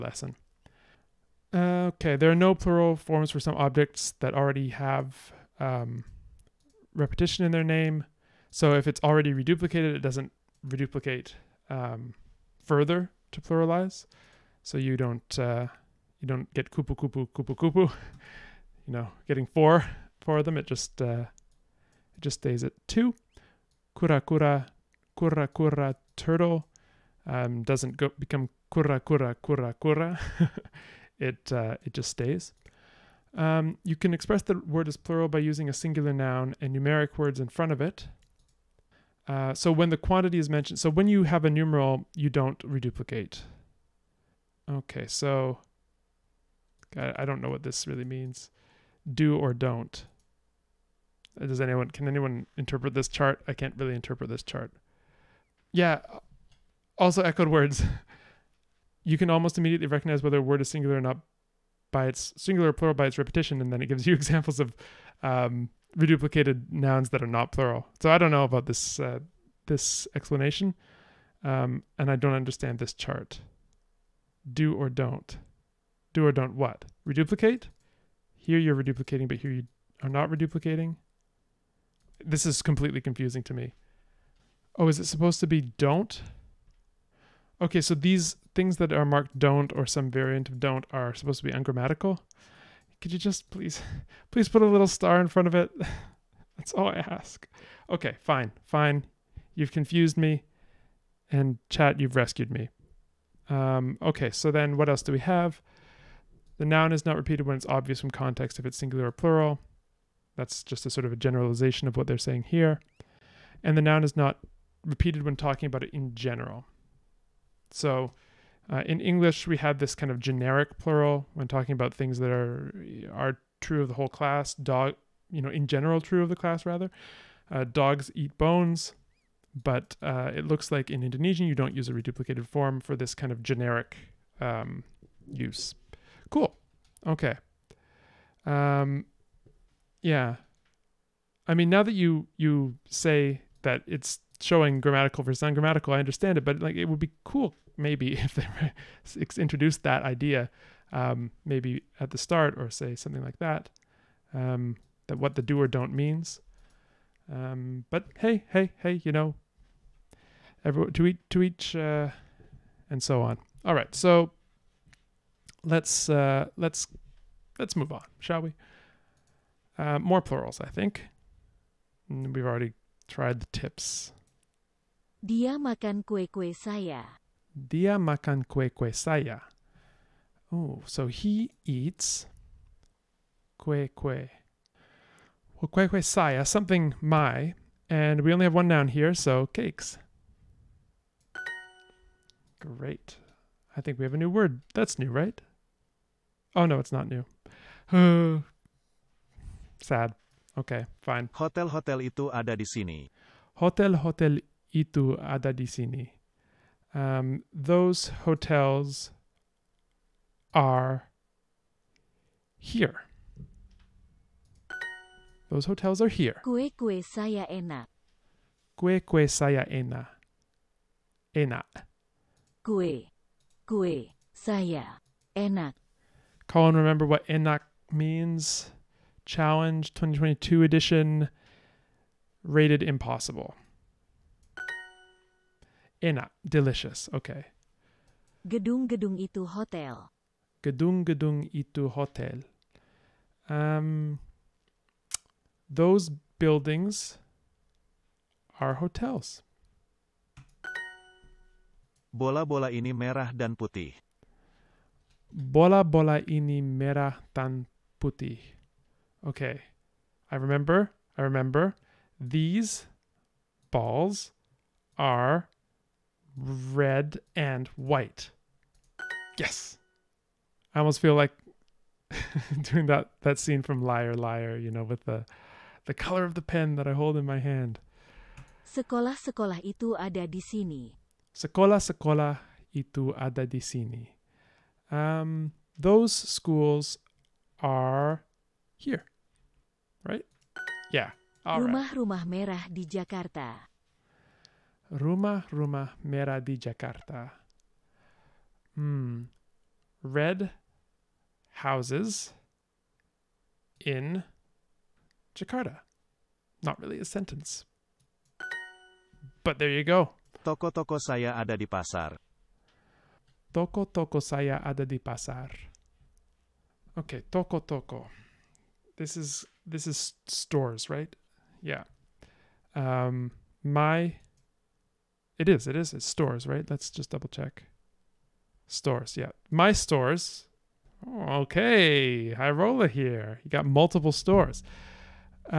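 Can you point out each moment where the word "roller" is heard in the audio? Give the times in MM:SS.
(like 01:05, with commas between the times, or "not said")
05:32.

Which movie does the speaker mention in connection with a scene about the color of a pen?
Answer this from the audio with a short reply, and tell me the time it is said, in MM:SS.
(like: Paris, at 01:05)
Liar Liar, at 04:33.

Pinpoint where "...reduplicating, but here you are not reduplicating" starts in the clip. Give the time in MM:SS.
01:18.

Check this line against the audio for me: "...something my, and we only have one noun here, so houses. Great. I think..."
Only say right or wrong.
wrong.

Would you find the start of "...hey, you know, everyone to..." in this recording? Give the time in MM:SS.
02:38.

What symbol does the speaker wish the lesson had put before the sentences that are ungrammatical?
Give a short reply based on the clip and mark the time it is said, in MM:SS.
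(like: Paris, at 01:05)
a little star, at 01:34.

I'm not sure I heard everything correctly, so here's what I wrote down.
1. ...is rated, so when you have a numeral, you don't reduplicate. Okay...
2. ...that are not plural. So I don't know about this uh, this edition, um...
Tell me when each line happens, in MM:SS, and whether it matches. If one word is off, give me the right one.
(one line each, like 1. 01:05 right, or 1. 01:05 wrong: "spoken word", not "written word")
1. 00:40 wrong: "mentioned", not "rated"
2. 01:07 wrong: "explanation", not "edition".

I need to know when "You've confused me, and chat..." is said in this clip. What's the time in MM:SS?
01:39.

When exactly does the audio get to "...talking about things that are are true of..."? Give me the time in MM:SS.
02:01.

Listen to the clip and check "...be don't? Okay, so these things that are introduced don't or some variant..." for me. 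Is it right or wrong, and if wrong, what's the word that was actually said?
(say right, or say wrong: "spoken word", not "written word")
wrong: "marked", not "introduced".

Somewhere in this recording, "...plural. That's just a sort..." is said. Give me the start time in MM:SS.
01:49.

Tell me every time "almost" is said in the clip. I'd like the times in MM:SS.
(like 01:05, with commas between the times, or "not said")
00:59, 04:30.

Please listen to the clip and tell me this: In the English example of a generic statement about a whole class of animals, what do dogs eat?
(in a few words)
bones.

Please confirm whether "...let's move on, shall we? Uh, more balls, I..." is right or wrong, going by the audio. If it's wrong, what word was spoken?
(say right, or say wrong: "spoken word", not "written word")
wrong: "plurals", not "balls".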